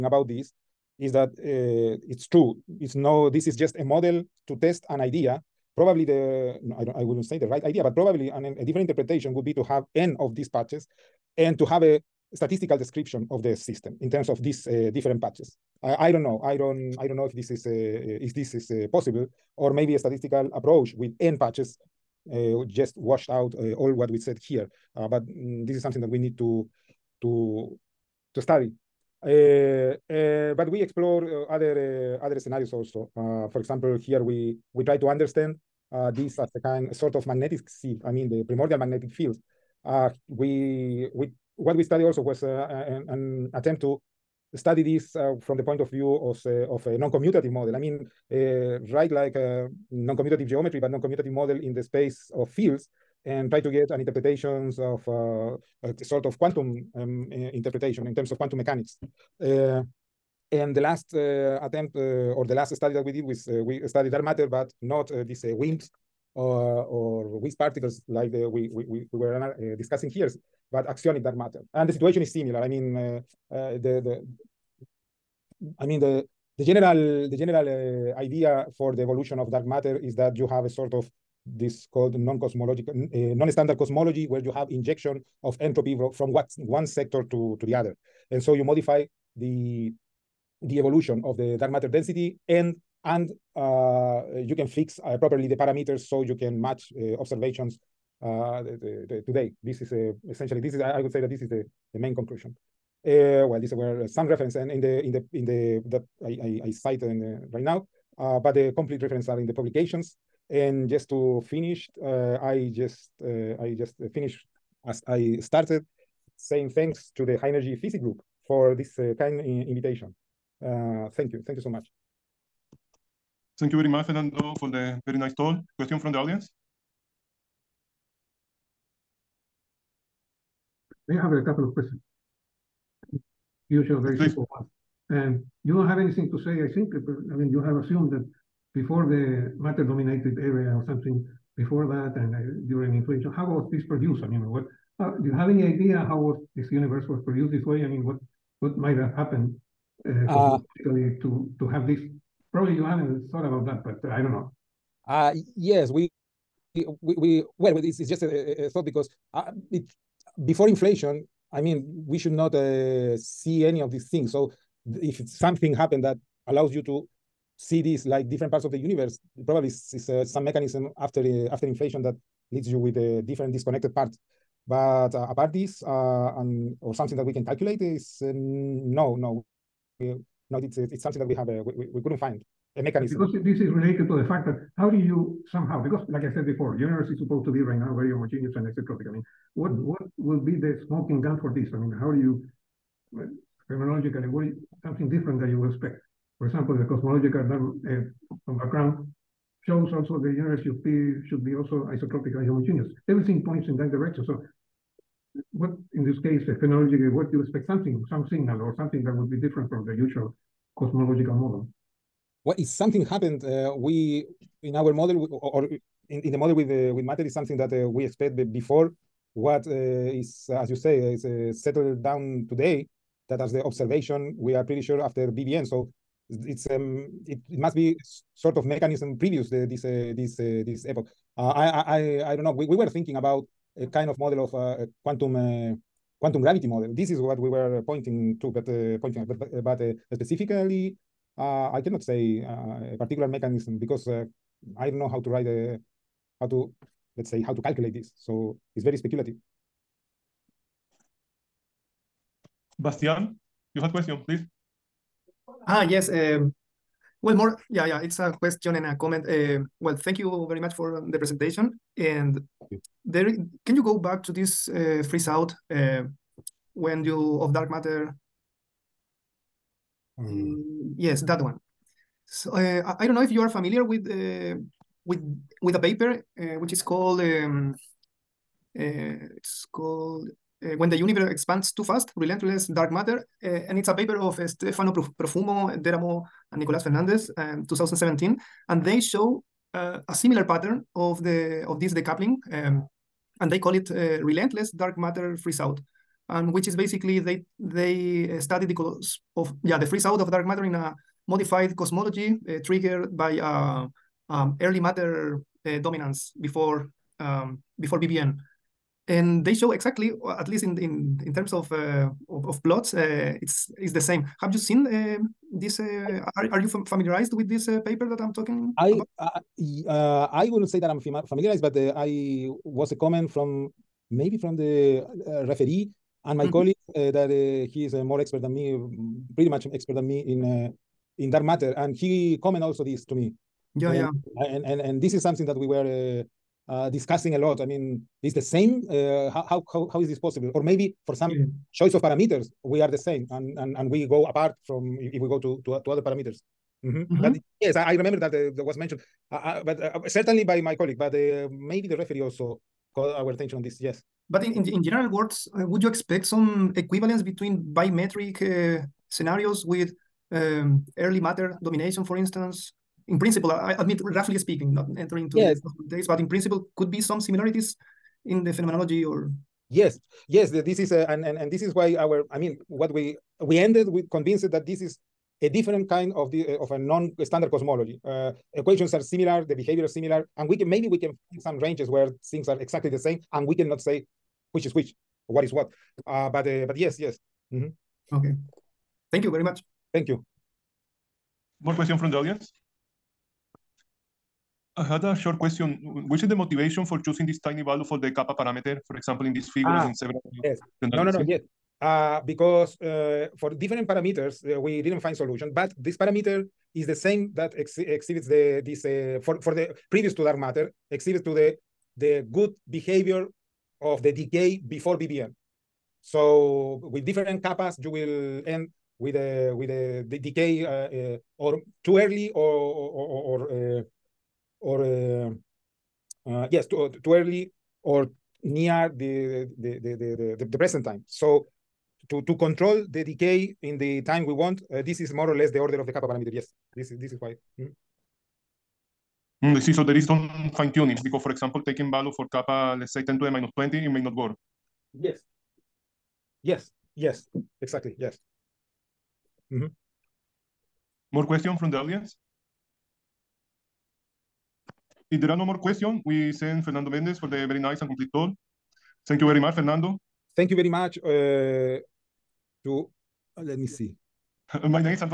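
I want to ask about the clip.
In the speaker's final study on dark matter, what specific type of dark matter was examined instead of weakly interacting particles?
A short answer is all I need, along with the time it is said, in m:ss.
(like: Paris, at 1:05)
axionic dark matter, at 1:10.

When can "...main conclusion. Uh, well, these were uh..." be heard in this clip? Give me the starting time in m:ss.
1:41.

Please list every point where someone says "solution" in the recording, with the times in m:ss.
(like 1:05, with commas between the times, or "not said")
6:45.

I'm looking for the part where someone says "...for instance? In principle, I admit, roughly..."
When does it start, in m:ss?
6:02.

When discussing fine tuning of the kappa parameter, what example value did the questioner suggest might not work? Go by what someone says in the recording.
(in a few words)
10^-20.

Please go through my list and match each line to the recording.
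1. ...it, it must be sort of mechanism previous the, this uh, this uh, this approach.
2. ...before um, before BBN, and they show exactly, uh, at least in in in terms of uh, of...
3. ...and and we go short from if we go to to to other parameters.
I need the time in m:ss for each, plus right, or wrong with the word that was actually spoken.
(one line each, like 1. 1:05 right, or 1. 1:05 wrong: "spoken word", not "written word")
1. 3:47 wrong: "epoch", not "approach"
2. 5:06 right
3. 5:43 wrong: "apart", not "short".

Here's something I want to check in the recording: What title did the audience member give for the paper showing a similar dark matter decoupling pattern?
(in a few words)
When the Universe Expands Too Fast.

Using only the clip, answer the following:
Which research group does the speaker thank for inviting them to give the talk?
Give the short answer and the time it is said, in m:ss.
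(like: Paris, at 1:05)
High Energy Physics Group, at 1:57.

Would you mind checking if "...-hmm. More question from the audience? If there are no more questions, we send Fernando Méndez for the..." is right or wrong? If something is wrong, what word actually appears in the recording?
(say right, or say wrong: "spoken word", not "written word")
right.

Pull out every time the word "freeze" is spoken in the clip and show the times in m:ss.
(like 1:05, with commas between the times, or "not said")
4:25, 4:55, 4:59.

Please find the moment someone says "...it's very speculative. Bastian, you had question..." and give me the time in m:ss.
4:08.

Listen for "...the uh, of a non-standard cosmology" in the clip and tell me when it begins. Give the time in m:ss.
6:16.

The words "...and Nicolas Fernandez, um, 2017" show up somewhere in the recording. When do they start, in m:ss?
4:46.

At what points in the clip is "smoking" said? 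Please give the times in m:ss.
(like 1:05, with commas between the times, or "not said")
3:10.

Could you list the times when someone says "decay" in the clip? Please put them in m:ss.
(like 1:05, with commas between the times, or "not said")
6:54, 7:00, 7:13.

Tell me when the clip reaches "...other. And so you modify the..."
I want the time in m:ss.
1:27.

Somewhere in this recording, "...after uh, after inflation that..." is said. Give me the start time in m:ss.
2:50.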